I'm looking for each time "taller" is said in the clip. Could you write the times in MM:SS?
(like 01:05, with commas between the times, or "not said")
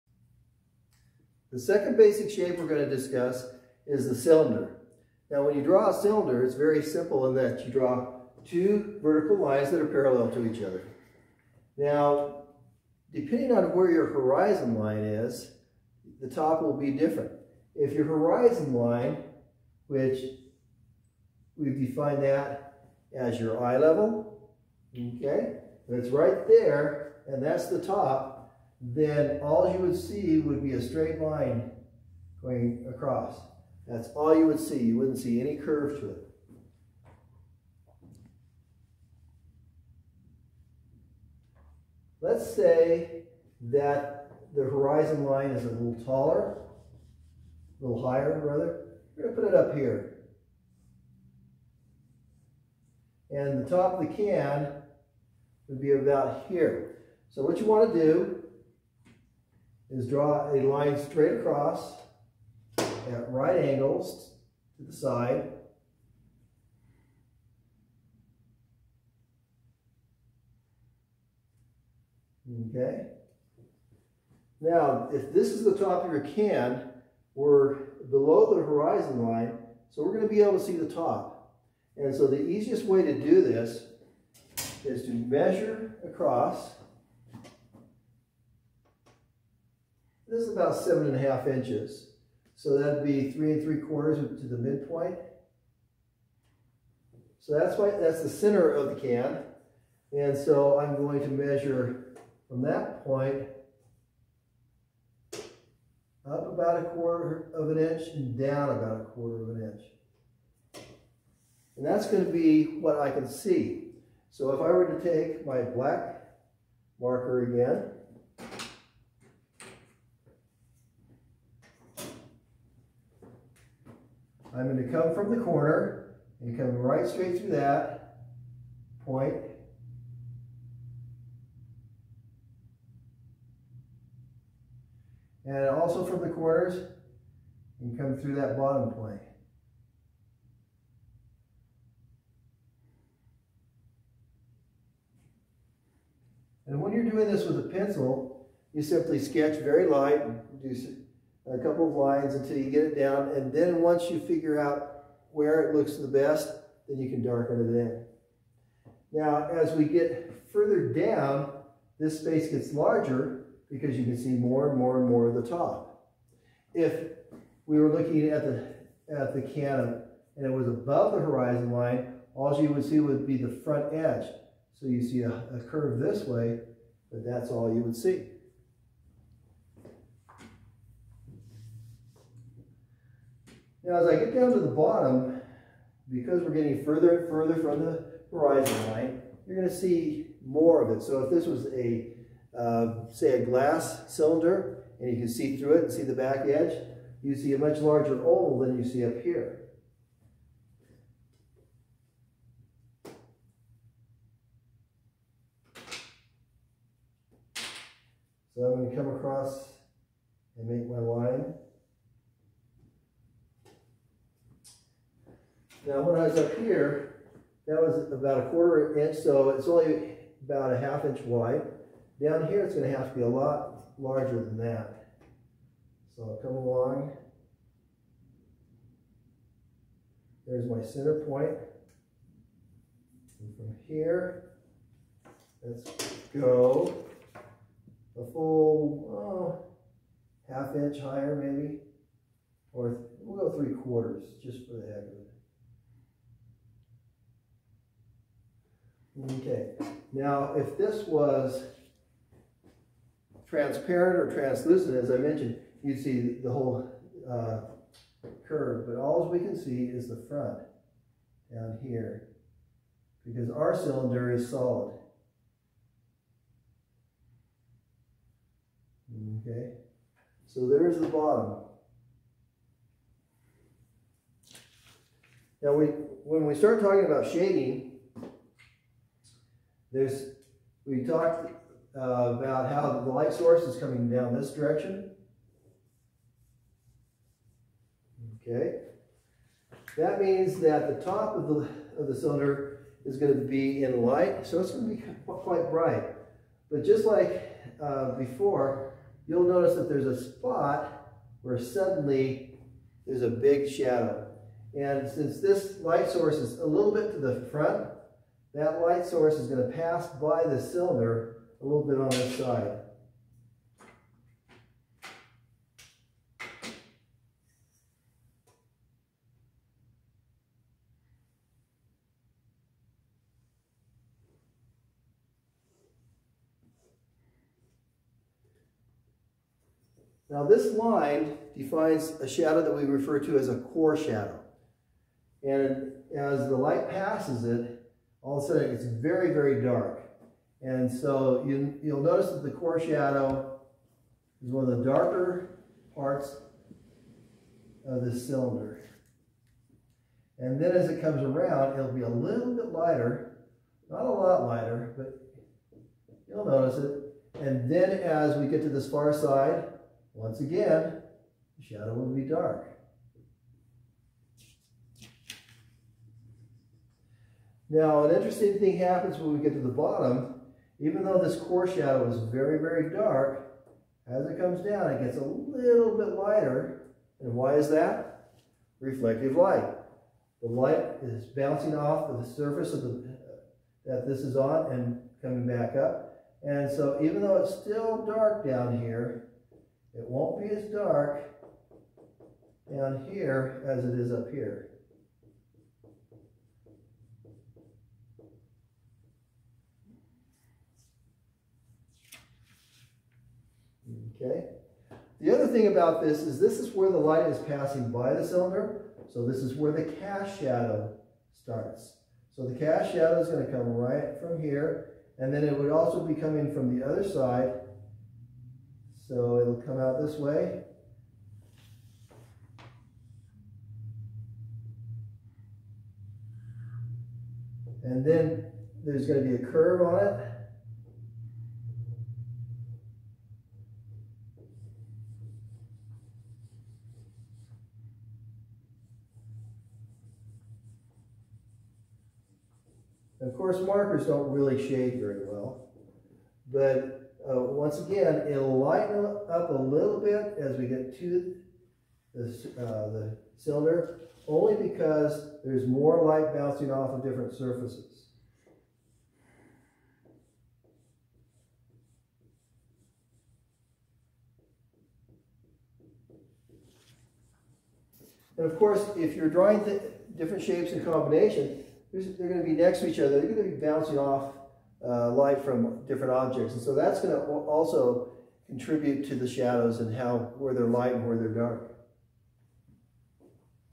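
00:46.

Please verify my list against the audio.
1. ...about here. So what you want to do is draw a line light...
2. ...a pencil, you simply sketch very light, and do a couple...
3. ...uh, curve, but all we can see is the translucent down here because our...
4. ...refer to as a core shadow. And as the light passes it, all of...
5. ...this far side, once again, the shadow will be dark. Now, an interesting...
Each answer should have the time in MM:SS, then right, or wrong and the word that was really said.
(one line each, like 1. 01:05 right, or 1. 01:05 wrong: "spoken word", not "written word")
1. 00:55 wrong: "straight", not "light"
2. 02:27 right
3. 04:17 wrong: "front", not "translucent"
4. 05:32 right
5. 05:58 right.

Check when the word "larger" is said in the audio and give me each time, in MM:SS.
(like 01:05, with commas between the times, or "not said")
02:42, 03:17, 03:43.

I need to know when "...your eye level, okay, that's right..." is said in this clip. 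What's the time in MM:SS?
00:23.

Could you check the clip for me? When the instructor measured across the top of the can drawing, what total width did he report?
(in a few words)
7.5 inches.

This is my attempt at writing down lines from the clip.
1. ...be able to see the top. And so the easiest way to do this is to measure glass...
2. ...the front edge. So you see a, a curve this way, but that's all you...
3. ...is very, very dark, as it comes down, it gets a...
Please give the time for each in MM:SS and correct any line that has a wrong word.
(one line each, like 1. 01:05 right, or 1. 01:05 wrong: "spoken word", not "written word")
1. 01:20 wrong: "across", not "glass"
2. 02:53 right
3. 06:12 right.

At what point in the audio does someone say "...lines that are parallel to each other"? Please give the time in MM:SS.
00:09.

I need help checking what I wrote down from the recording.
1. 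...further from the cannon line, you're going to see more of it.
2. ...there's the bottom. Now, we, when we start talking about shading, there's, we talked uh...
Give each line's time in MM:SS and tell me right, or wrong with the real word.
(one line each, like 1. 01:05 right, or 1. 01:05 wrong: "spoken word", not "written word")
1. 03:07 wrong: "horizon", not "cannon"
2. 04:30 right.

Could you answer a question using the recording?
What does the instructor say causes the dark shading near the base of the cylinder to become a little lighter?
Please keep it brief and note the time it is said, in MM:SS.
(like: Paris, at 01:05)
reflective light, at 06:18.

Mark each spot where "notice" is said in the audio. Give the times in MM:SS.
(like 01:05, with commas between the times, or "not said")
04:59, 05:42, 05:56.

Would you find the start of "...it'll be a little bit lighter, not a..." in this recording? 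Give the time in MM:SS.
05:51.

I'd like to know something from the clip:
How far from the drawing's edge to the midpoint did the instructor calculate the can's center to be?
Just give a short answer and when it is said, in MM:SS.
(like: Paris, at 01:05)
3.75, at 01:33.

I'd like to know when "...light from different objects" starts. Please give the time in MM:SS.
07:55.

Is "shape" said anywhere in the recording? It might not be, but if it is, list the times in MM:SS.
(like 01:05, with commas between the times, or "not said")
00:02, 07:50.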